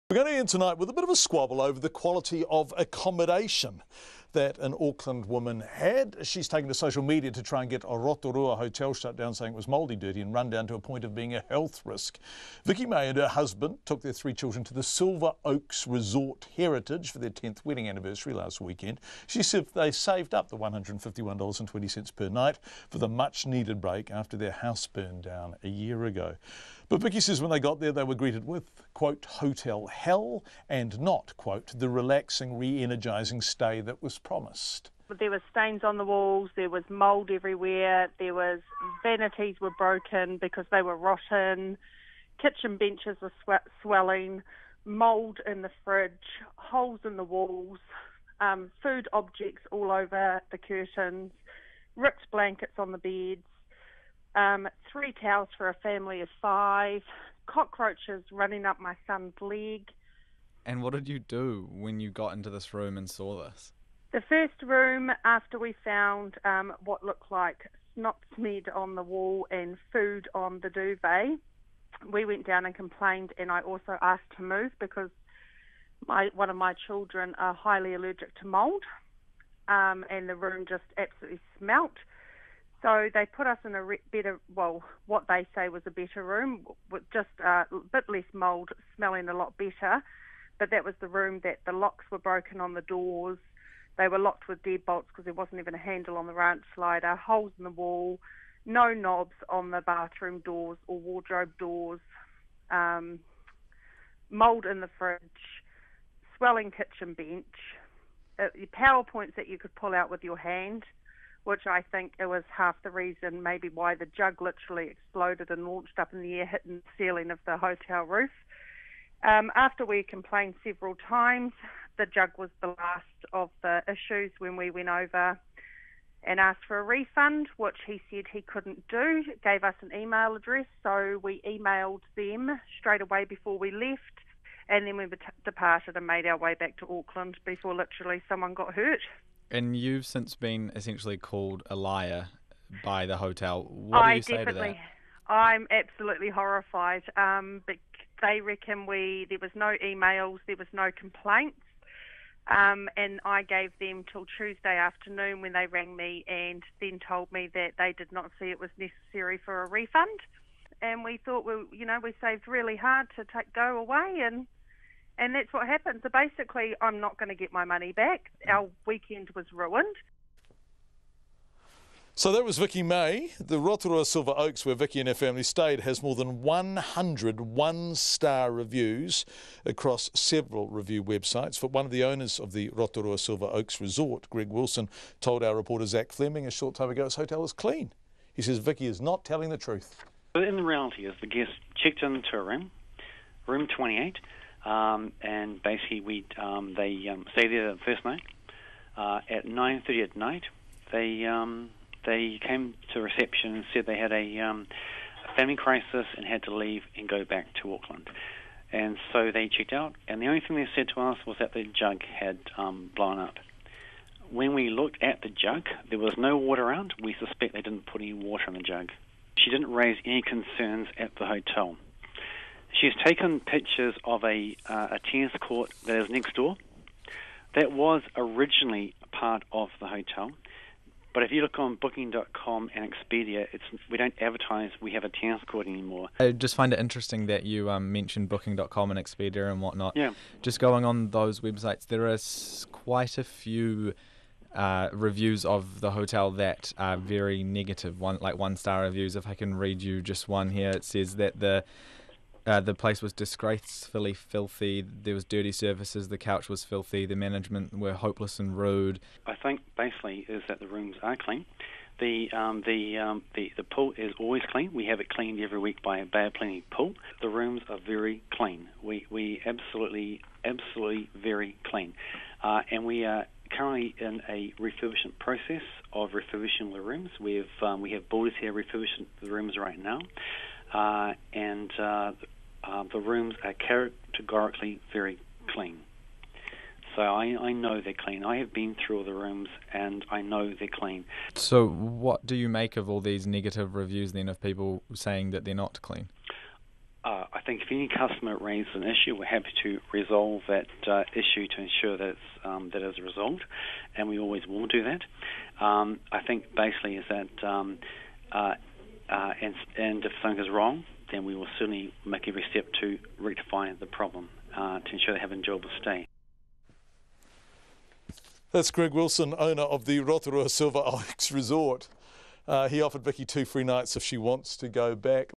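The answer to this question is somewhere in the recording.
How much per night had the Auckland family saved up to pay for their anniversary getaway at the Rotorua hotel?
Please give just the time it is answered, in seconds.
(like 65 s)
20 s.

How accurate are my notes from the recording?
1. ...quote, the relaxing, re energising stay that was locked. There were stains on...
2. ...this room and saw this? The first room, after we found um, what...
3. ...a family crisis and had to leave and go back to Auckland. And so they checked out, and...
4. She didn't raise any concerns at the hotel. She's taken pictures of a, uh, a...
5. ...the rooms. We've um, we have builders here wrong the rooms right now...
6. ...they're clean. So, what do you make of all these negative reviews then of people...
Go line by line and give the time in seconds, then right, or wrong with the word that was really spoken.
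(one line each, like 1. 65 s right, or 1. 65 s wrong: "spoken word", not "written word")
1. 31 s wrong: "promised", not "locked"
2. 62 s right
3. 205 s right
4. 219 s right
5. 276 s wrong: "refurbishing", not "wrong"
6. 290 s right.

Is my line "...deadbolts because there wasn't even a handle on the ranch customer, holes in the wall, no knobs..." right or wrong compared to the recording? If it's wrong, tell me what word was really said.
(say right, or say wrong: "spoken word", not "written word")
wrong: "slider", not "customer".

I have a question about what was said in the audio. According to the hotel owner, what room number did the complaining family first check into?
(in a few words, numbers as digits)
28.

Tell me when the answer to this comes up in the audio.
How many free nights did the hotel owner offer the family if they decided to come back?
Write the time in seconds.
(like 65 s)
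323 s.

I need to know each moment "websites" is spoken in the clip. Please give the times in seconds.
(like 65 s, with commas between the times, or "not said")
181 s, 241 s.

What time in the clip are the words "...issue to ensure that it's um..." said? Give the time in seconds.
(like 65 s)
301 s.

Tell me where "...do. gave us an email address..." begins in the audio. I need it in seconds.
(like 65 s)
128 s.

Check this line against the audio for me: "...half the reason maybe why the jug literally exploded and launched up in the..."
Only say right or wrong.
right.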